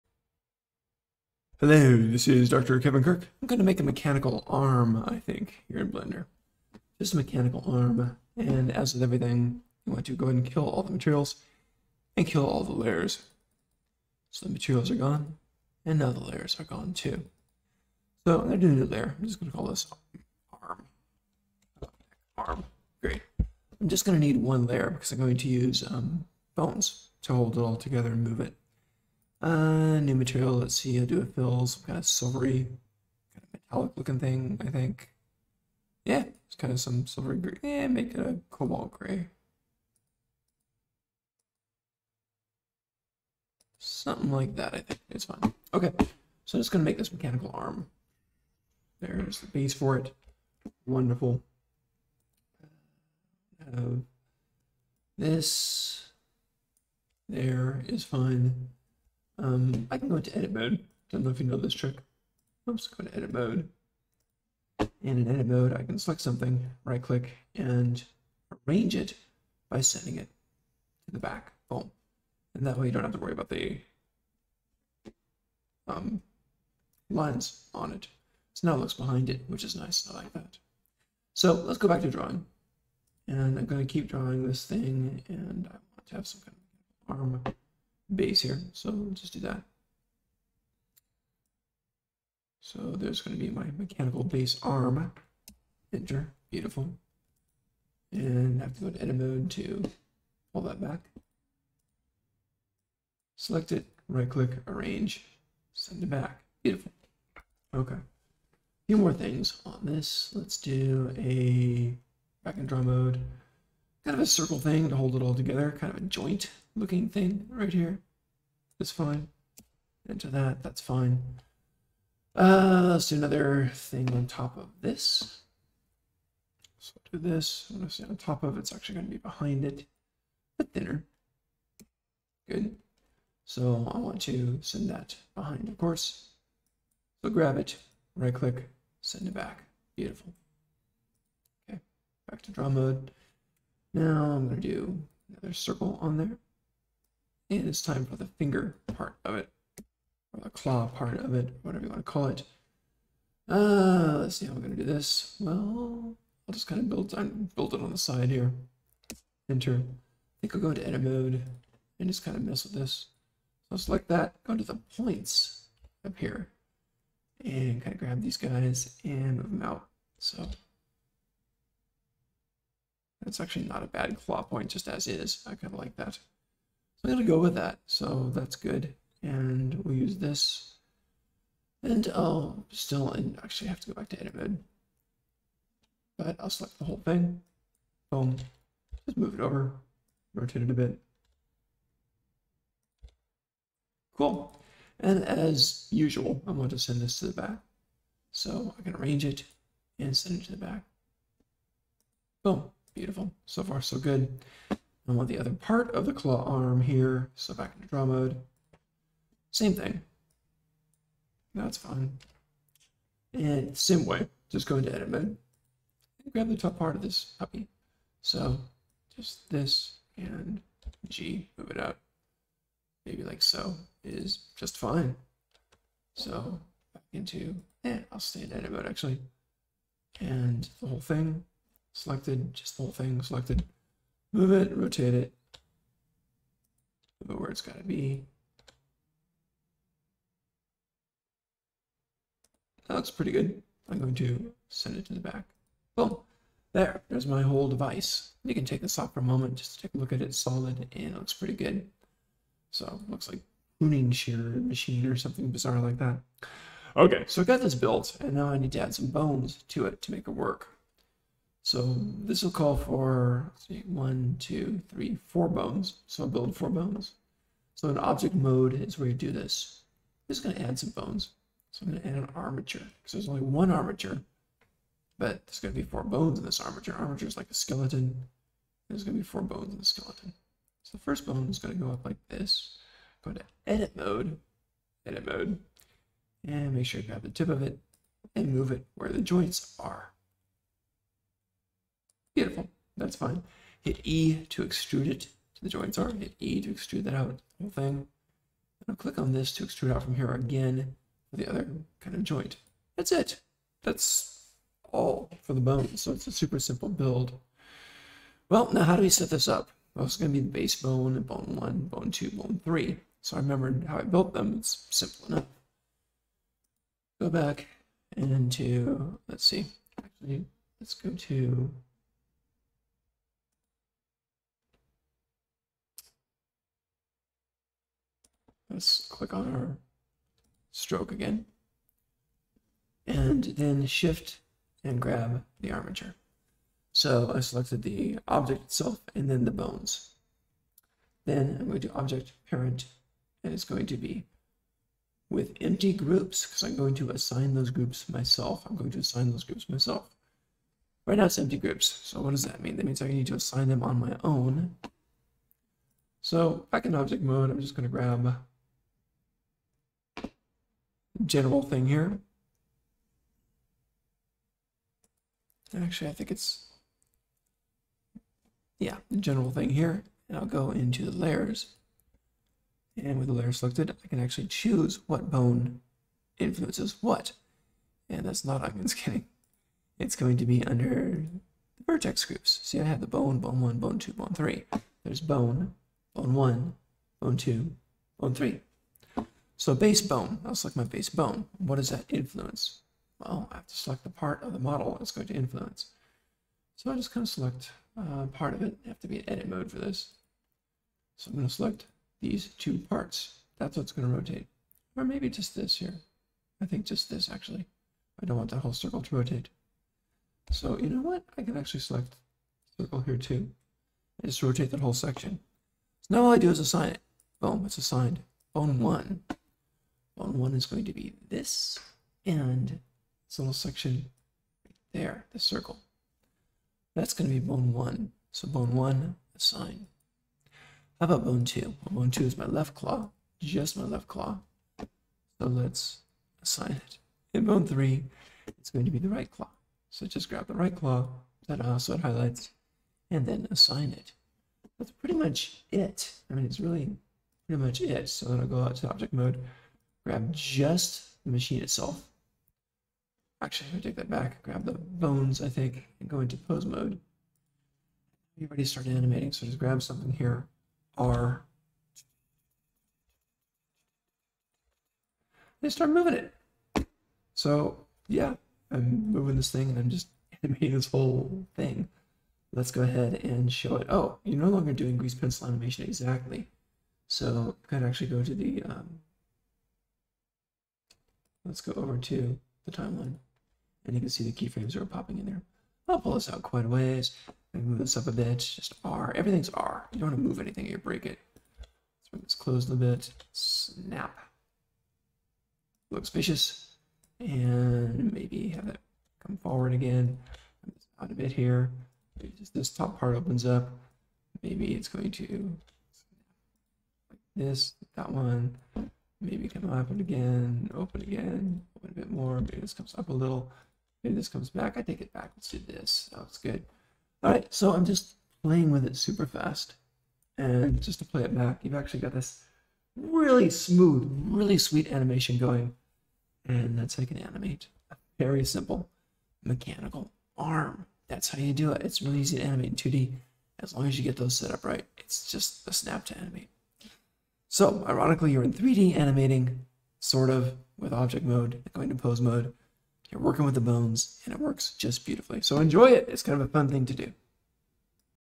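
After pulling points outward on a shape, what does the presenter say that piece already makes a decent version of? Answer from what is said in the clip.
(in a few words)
Claw point.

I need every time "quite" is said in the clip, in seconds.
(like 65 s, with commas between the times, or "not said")
486 s.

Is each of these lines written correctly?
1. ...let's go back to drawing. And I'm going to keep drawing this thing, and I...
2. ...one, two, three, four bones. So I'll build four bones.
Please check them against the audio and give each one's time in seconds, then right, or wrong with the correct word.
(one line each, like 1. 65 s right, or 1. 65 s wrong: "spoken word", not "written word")
1. 81 s right
2. 263 s right.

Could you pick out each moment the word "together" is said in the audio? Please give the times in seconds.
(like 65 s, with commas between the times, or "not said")
27 s, 115 s.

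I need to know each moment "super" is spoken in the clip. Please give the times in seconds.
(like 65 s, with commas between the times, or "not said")
306 s, 518 s.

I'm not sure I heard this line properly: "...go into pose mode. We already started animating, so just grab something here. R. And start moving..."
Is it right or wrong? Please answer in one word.
right.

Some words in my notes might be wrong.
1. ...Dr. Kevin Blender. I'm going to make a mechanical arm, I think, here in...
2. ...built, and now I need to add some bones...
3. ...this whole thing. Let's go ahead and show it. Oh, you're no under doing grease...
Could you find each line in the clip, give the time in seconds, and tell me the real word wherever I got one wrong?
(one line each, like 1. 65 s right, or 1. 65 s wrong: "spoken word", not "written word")
1. 2 s wrong: "Kirk", not "Blender"
2. 257 s right
3. 470 s wrong: "longer", not "under".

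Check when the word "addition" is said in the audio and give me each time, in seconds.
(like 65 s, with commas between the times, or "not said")
not said.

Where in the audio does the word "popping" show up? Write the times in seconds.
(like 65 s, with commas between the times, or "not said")
484 s.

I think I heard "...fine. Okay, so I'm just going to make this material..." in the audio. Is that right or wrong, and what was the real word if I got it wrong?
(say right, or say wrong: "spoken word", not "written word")
wrong: "mechanical", not "material".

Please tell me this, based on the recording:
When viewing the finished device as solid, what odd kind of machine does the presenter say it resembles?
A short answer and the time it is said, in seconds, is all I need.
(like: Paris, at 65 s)
Pruning shear machine, at 253 s.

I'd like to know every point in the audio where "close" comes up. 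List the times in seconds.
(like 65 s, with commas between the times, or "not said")
492 s.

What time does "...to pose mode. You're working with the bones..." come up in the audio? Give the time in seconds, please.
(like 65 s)
541 s.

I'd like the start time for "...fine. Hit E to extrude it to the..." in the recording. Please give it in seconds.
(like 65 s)
293 s.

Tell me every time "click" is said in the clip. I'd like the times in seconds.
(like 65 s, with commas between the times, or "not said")
67 s, 104 s, 138 s, 298 s, 329 s.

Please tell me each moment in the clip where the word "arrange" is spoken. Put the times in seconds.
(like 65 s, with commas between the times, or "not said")
68 s, 104 s, 198 s.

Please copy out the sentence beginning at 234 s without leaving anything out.
Move it, rotate it, move it where it's got to be.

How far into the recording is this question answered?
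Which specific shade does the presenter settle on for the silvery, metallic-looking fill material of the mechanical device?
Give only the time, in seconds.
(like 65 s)
38 s.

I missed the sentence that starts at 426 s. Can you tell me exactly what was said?
That's going to be bone one.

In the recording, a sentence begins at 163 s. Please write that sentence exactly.
So I'll select that, go to the points up here, and kind of grab these guys and move them out.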